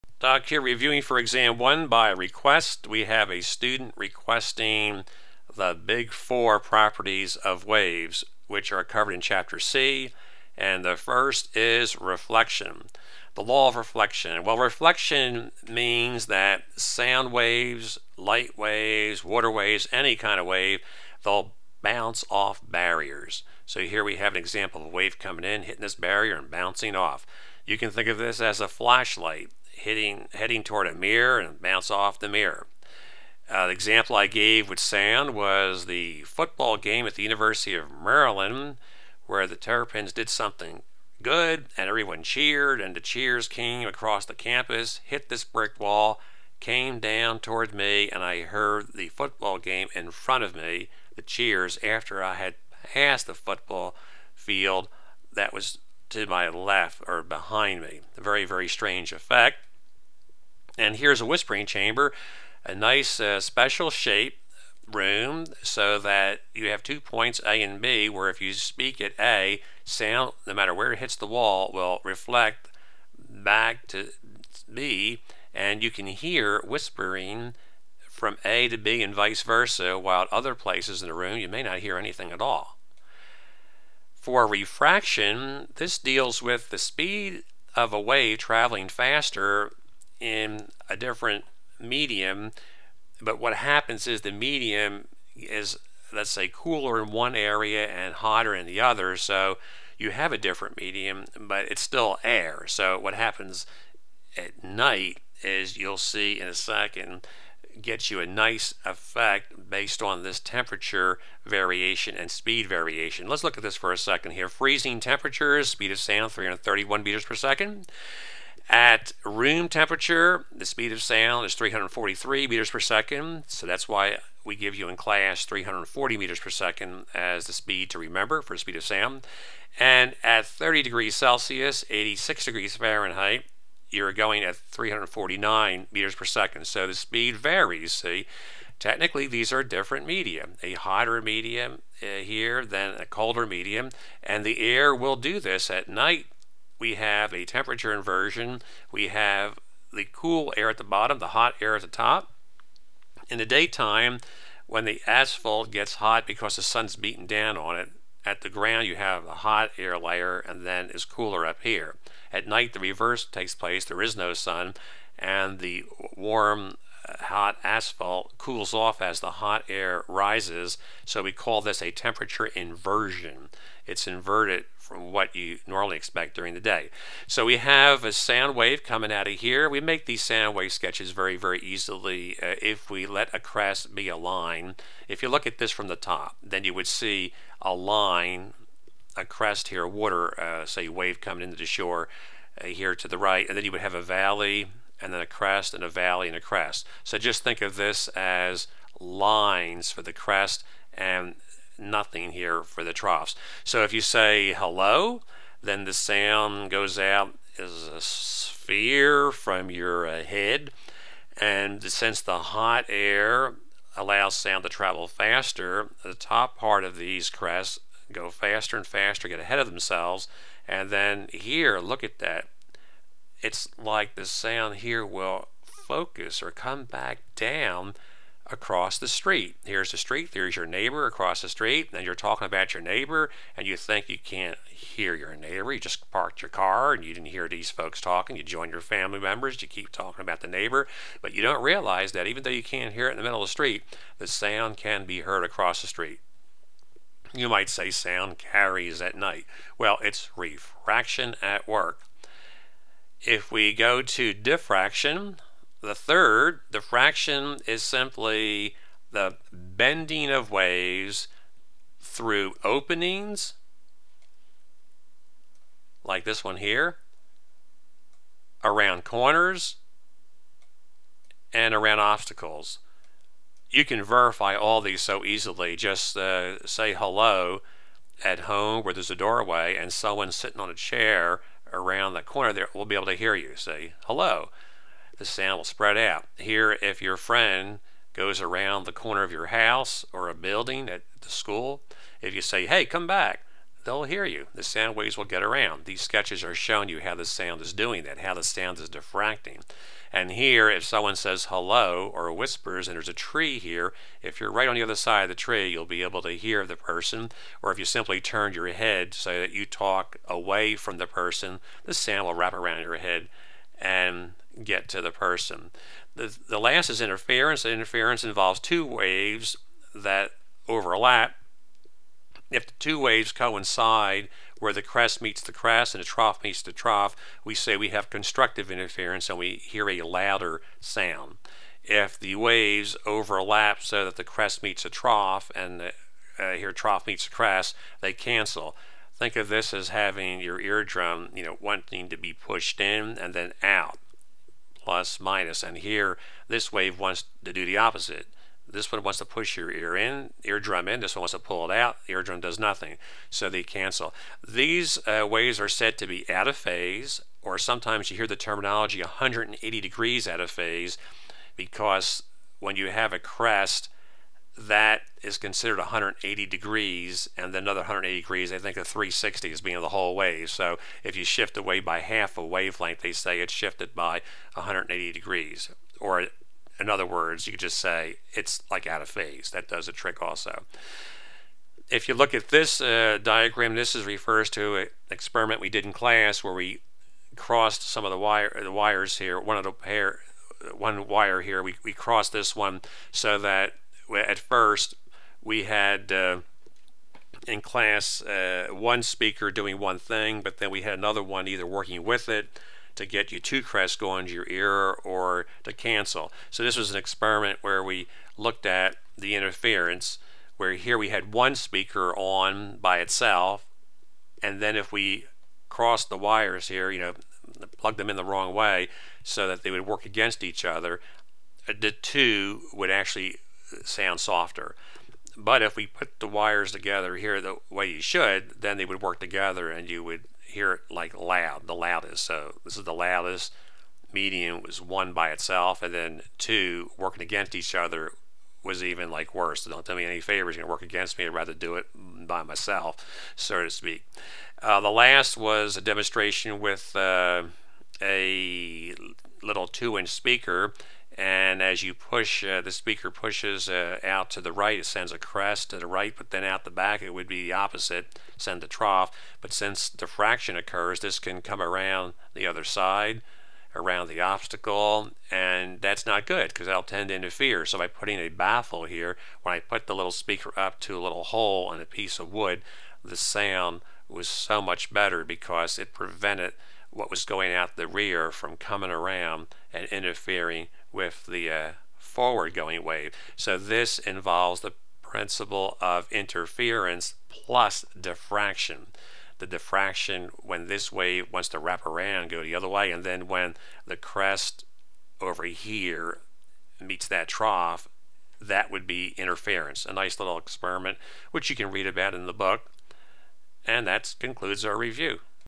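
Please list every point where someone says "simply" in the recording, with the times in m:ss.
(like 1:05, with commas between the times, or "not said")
4:17, 5:07.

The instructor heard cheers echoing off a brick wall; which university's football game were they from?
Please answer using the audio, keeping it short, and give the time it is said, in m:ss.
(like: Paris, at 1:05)
University of Maryland, at 0:37.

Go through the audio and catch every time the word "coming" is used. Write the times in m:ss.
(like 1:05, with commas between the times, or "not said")
0:25, 2:58, 3:11, 7:58.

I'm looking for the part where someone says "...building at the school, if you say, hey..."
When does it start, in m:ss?
4:50.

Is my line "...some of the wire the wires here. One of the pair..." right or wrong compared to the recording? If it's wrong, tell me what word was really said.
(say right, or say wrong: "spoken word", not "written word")
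right.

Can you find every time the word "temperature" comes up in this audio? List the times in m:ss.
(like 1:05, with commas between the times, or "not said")
1:50, 1:54, 1:59, 2:27, 2:51.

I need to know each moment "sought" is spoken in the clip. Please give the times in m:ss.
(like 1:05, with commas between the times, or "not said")
not said.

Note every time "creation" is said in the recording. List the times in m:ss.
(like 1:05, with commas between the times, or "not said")
not said.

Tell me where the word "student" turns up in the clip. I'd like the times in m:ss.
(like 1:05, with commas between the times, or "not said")
0:03.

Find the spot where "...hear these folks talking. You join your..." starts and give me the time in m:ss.
3:57.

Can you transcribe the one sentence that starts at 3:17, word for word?
So just think of this as lines for the crest and nothing here for the troughs.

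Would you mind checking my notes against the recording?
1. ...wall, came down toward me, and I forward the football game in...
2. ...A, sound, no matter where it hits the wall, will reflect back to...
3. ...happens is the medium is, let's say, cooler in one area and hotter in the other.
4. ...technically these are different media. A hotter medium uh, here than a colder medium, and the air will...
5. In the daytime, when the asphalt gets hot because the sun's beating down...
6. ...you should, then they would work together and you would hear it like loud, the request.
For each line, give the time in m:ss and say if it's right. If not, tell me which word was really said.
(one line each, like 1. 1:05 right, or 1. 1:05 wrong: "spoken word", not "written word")
1. 0:45 wrong: "heard", not "forward"
2. 1:09 right
3. 1:33 right
4. 2:18 right
5. 2:33 right
6. 7:07 wrong: "loudest", not "request".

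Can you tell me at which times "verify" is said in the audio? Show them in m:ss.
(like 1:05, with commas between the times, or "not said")
4:34.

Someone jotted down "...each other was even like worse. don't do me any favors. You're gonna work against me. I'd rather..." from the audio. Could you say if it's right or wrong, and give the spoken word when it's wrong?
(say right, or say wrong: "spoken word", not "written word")
right.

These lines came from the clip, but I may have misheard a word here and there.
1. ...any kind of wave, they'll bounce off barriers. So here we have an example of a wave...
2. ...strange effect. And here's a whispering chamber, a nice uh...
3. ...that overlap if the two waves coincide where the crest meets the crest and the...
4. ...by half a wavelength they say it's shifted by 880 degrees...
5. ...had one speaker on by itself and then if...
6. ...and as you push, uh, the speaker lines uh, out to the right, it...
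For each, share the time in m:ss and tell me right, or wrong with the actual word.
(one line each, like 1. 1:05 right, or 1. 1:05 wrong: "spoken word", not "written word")
1. 0:19 right
2. 0:58 right
3. 5:19 right
4. 6:11 wrong: "180", not "880"
5. 6:51 right
6. 7:31 wrong: "pushes", not "lines".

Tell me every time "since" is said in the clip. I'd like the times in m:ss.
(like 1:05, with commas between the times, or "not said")
3:31, 7:39.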